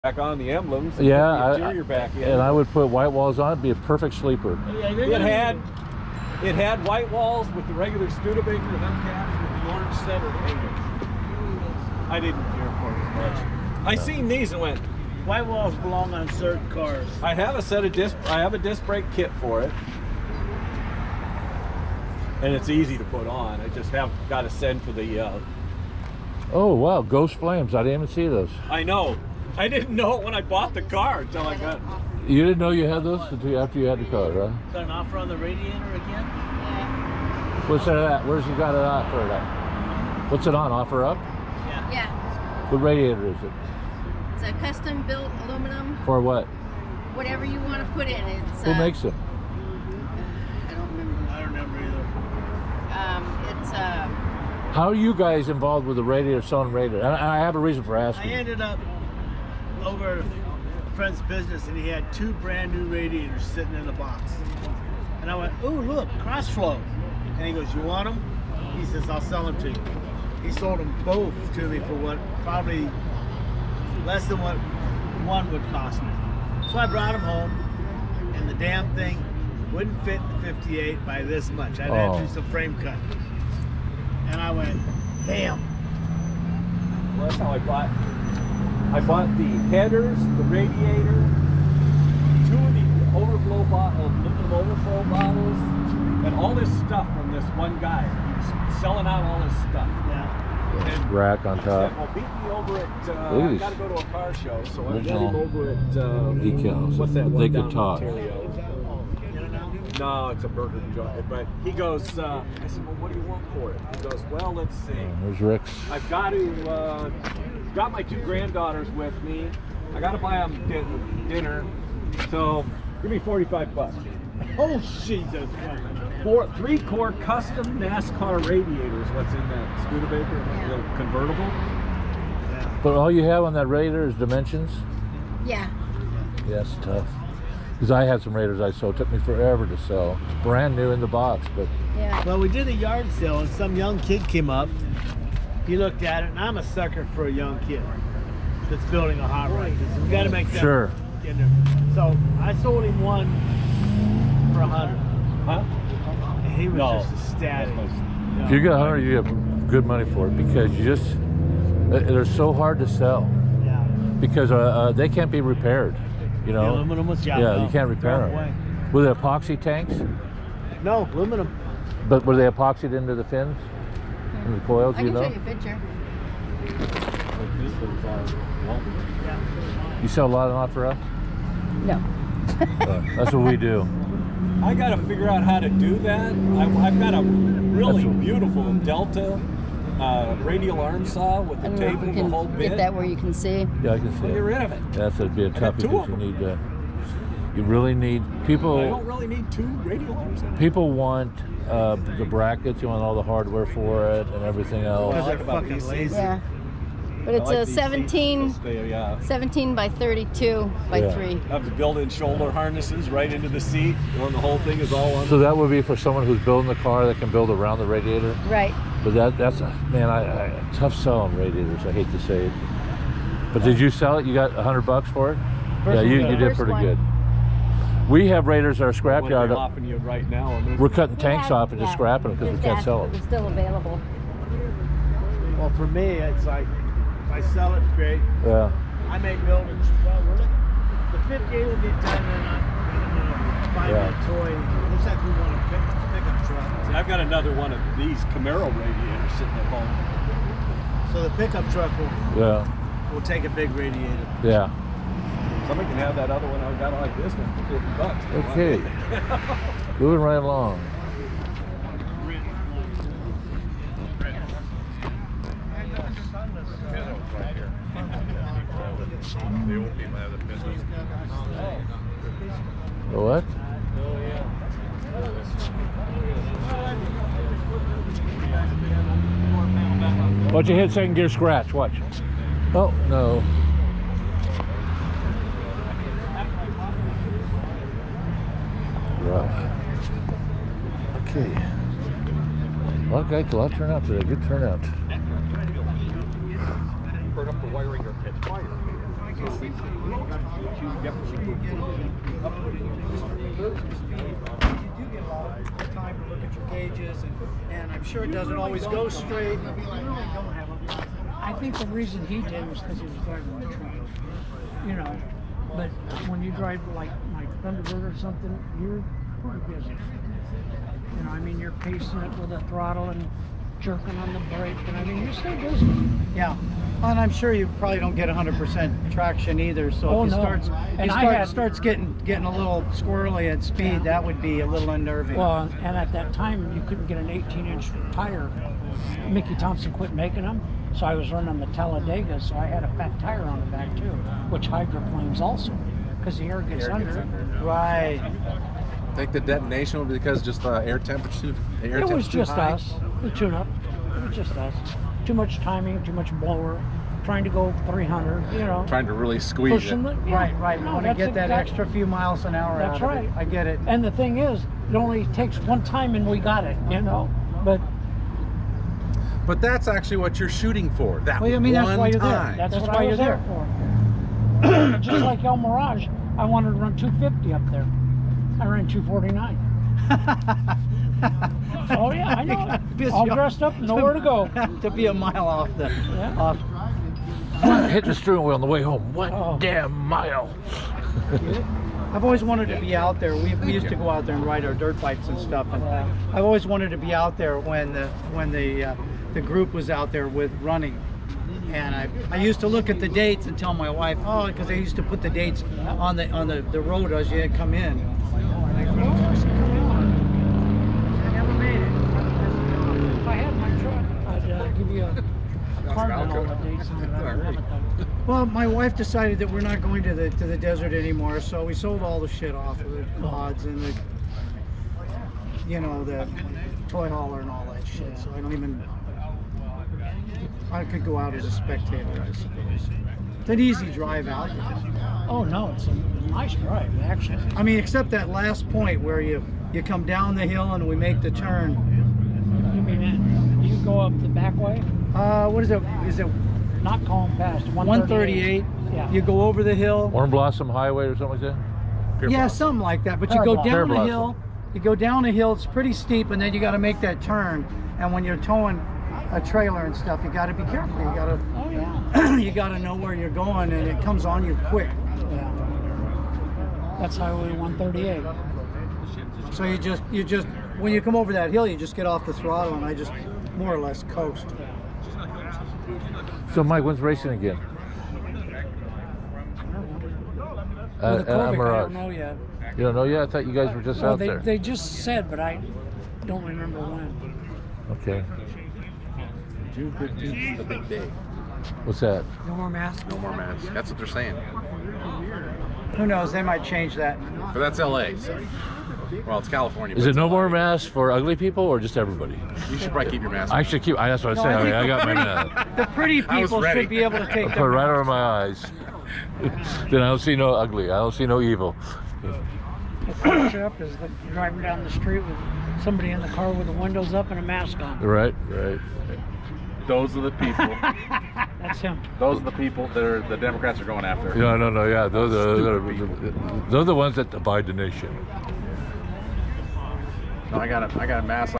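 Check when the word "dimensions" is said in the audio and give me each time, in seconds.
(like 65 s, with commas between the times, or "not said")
134 s.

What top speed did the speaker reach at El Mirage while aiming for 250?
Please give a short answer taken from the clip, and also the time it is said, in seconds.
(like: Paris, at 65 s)
249, at 378 s.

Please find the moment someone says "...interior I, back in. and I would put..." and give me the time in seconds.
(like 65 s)
1 s.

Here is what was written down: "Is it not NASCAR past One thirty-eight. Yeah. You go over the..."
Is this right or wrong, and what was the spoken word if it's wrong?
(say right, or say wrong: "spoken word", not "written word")
wrong: "Calm", not "NASCAR".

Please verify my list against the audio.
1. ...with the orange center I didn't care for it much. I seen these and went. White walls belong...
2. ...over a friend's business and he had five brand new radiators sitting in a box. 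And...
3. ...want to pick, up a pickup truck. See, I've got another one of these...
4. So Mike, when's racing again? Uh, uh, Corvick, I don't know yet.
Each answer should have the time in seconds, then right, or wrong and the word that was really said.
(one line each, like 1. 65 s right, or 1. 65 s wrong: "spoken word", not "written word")
1. 9 s right
2. 59 s wrong: "two", not "five"
3. 245 s right
4. 476 s right.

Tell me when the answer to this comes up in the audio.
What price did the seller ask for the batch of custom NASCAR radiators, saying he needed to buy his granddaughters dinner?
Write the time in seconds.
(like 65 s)
123 s.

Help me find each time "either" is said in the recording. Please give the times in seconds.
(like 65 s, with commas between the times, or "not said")
51 s, 329 s.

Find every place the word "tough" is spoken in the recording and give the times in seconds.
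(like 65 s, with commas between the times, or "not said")
136 s, 195 s, 220 s.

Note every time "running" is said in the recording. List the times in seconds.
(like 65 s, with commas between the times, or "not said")
341 s, 400 s.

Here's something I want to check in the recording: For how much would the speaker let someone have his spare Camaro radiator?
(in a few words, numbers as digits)
$50.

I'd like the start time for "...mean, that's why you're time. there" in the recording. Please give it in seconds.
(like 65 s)
371 s.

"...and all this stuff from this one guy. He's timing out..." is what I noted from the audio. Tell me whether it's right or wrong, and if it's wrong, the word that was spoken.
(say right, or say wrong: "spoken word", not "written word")
wrong: "selling", not "timing".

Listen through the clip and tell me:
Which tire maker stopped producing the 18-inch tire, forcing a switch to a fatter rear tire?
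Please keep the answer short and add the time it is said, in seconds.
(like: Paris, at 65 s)
Mickey Thompson, at 339 s.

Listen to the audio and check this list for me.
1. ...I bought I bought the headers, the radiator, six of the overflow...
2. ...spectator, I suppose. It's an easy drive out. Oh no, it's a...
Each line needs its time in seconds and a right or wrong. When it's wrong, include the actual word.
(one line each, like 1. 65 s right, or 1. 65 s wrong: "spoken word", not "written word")
1. 87 s wrong: "two", not "six"
2. 431 s right.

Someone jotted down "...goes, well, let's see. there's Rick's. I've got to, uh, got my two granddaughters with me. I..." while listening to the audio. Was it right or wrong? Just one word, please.
right.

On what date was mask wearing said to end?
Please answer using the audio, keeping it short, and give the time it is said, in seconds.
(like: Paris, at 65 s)
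June 15th, at 489 s.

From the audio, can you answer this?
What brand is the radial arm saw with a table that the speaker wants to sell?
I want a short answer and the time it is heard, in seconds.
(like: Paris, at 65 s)
Delta, at 188 s.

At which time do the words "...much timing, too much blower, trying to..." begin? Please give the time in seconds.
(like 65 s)
355 s.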